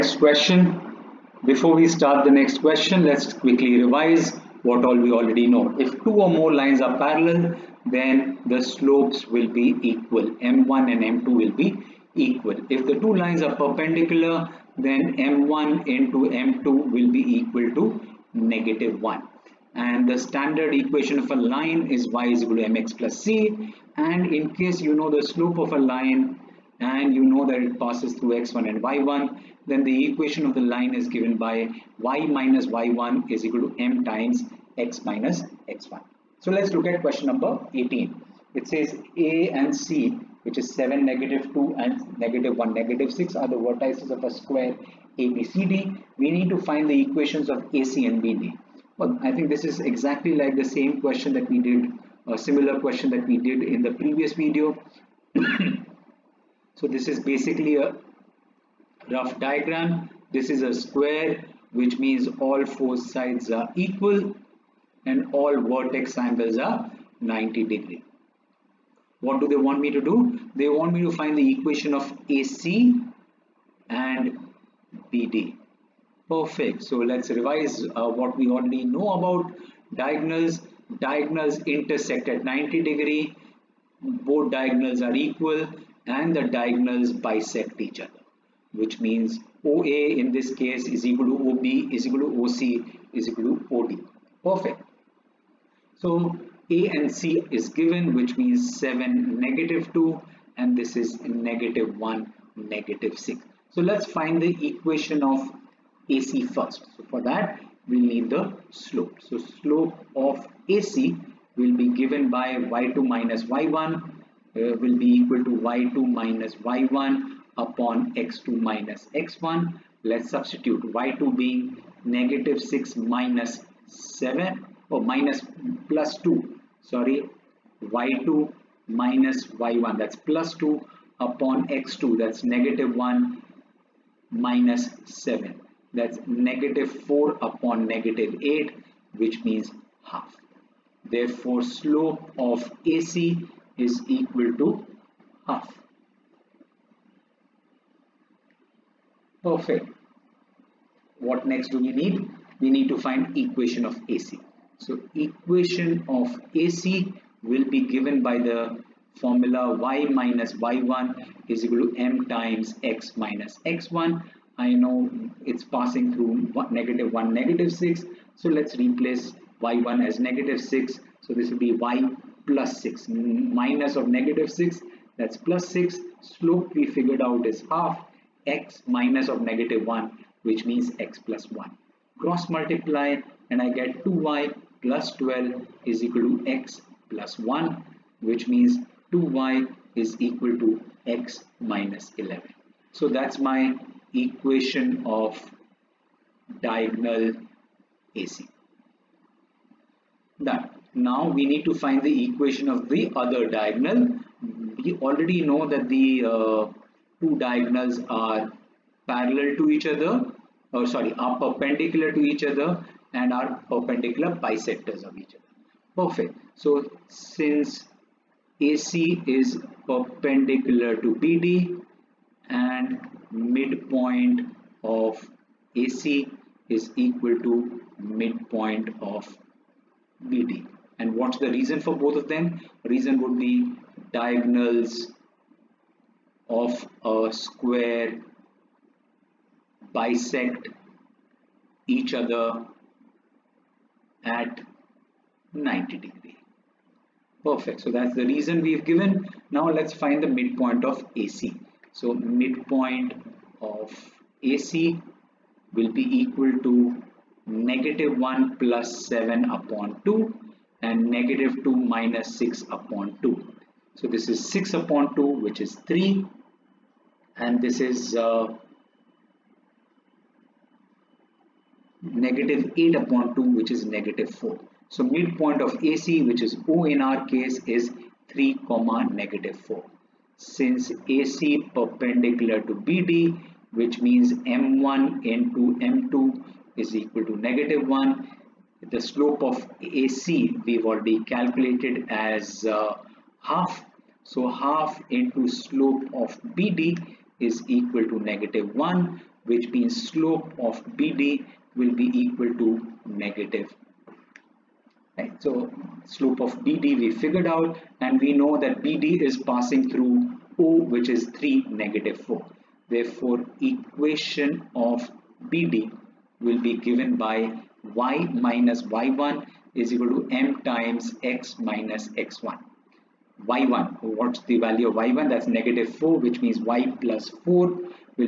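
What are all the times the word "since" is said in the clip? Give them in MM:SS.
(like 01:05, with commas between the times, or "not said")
03:37, 04:40.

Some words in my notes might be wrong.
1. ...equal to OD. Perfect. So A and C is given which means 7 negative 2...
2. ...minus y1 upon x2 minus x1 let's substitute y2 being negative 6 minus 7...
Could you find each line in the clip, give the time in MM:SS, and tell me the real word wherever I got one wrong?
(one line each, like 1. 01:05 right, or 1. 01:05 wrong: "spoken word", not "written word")
1. 01:33 right
2. 01:56 right.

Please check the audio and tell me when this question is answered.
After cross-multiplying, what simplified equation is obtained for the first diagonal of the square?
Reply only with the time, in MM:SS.
03:09.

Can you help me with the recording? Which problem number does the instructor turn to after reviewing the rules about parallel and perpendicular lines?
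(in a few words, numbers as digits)
18.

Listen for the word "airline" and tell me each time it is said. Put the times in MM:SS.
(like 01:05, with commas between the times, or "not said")
not said.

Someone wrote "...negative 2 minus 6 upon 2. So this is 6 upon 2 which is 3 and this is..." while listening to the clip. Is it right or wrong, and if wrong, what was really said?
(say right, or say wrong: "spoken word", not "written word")
right.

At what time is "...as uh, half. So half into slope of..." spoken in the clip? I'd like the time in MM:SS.
04:52.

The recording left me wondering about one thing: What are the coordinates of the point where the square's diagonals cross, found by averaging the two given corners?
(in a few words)
(3, -4).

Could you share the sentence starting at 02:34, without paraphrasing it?
So equation of AC will be given by the formula y minus y1 is equal to m times x minus x1.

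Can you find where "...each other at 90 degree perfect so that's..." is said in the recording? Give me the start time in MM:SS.
04:01.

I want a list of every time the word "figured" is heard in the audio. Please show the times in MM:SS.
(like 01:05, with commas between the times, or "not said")
02:56, 05:07.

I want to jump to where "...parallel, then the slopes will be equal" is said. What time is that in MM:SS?
00:06.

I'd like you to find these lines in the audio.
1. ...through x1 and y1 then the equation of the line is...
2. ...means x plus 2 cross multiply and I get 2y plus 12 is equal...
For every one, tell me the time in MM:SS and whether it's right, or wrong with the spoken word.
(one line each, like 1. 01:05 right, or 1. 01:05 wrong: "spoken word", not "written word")
1. 00:28 right
2. 03:00 wrong: "1", not "2".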